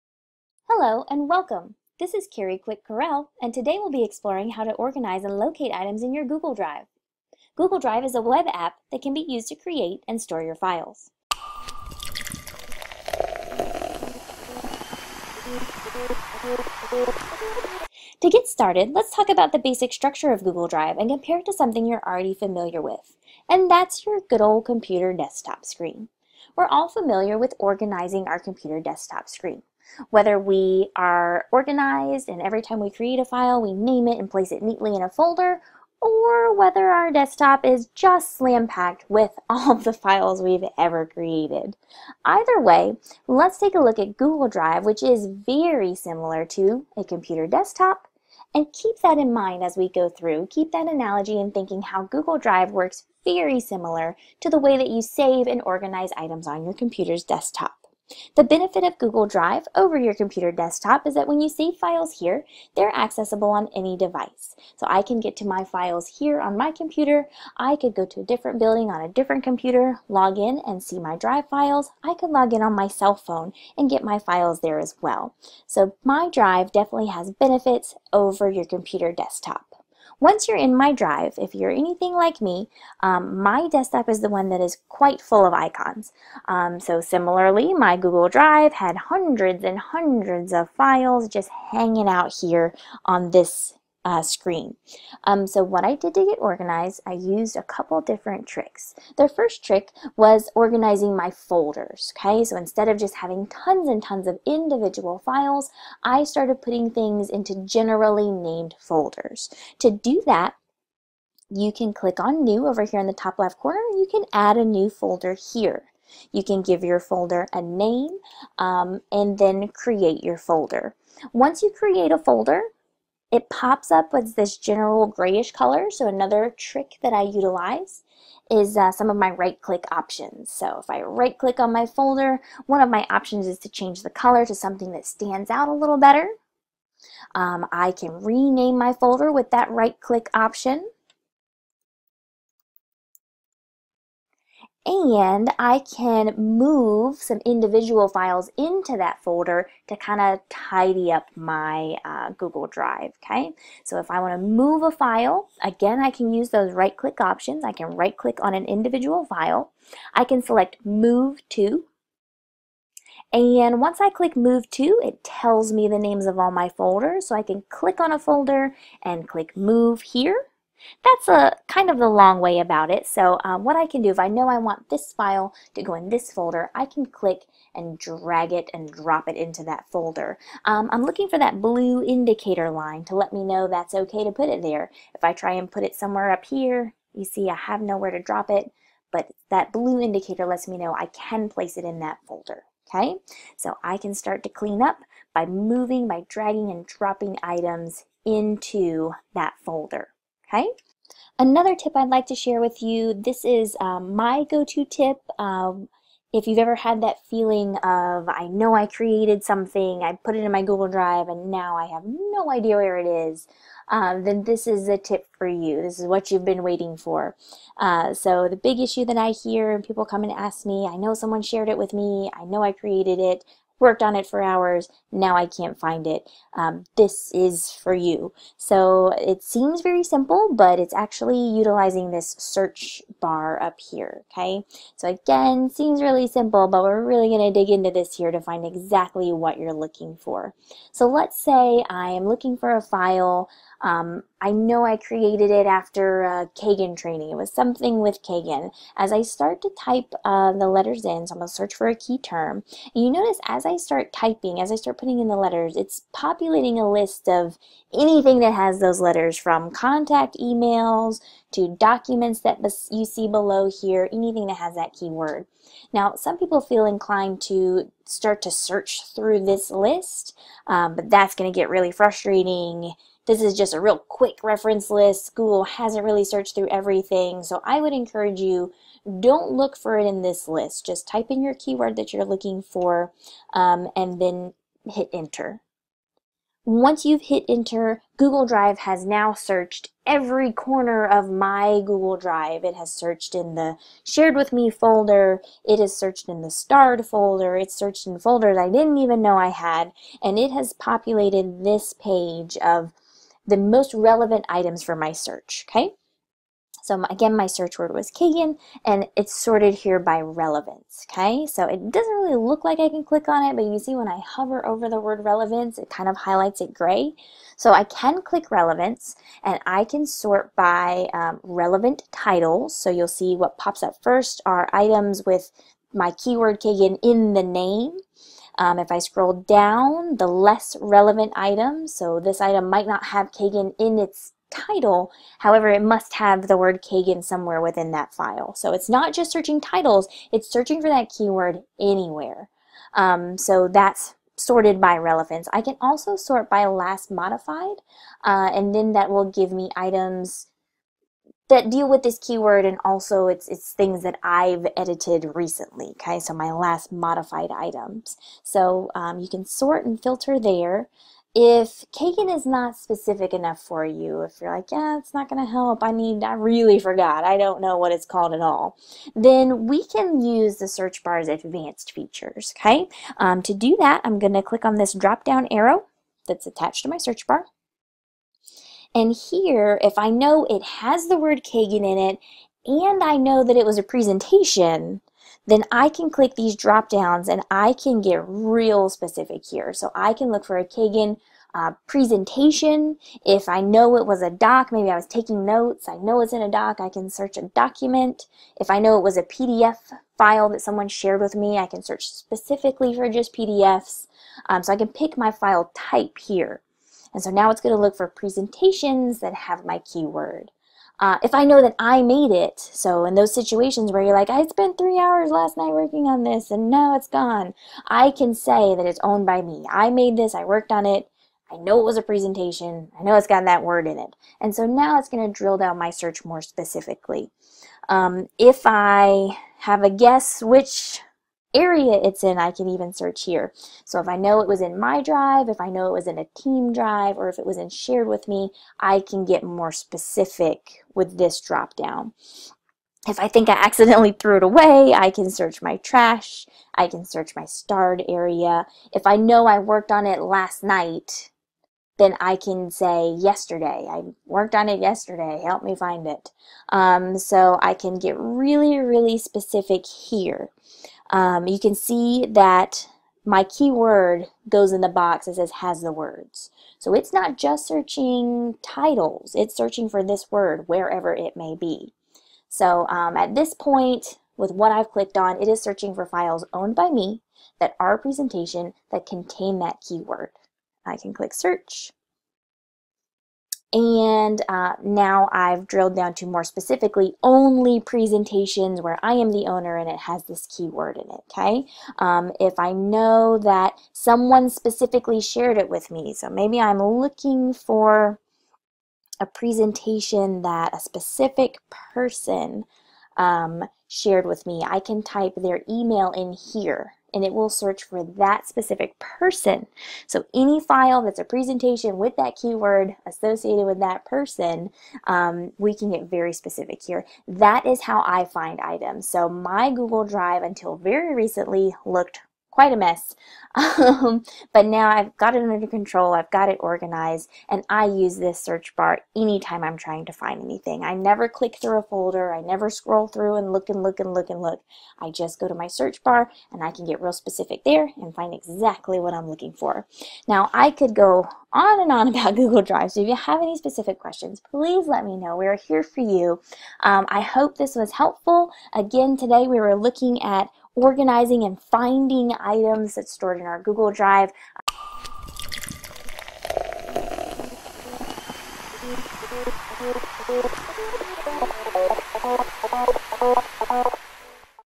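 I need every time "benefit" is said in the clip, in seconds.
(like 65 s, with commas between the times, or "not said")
58 s, 77 s.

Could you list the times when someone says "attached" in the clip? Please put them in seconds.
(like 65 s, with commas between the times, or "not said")
376 s.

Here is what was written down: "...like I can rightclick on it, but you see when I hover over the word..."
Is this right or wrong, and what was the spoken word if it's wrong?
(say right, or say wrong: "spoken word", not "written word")
wrong: "click", not "rightclick".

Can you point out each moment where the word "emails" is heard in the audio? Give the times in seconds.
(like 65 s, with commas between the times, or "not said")
260 s, 505 s.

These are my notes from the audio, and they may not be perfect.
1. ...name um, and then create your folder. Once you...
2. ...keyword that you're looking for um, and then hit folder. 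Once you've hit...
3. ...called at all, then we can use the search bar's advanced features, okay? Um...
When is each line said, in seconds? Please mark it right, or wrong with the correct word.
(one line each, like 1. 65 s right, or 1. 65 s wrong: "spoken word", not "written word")
1. 117 s right
2. 281 s wrong: "enter", not "folder"
3. 368 s right.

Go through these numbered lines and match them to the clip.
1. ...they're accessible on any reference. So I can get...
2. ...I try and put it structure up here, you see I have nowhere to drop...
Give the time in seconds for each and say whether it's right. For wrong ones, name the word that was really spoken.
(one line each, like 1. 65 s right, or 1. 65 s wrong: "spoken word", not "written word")
1. 62 s wrong: "device", not "reference"
2. 185 s wrong: "somewhere", not "structure".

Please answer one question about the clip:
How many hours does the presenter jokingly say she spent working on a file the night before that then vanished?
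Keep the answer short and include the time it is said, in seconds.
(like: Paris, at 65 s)
3, at 414 s.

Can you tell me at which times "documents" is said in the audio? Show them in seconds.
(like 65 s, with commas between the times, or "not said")
261 s, 397 s.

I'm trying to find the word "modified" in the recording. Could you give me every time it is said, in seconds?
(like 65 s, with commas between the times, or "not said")
347 s, 356 s.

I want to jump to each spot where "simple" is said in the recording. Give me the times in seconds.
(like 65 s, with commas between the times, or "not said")
230 s, 236 s.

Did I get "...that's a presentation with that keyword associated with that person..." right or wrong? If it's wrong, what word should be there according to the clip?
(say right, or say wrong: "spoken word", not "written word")
right.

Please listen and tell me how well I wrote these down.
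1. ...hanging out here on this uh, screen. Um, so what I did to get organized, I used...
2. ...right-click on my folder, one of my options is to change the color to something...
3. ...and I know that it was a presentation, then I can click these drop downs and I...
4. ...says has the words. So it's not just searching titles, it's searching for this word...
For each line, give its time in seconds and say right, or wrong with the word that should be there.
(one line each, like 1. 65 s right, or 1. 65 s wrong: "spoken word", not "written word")
1. 91 s right
2. 131 s right
3. 382 s right
4. 465 s right.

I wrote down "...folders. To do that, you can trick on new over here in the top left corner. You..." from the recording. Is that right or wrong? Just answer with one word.
wrong.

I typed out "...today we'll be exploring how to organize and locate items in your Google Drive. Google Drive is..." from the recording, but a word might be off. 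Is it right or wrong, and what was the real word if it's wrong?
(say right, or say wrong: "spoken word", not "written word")
right.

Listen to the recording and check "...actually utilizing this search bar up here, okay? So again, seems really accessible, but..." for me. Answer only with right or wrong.
wrong.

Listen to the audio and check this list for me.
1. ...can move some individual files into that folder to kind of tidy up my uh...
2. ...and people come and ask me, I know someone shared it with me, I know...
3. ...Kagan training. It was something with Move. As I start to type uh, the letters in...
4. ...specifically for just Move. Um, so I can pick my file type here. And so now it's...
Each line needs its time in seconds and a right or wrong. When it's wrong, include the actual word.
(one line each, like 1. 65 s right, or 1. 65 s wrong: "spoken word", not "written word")
1. 145 s right
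2. 219 s right
3. 246 s wrong: "Kagan", not "Move"
4. 402 s wrong: "PDFs", not "Move".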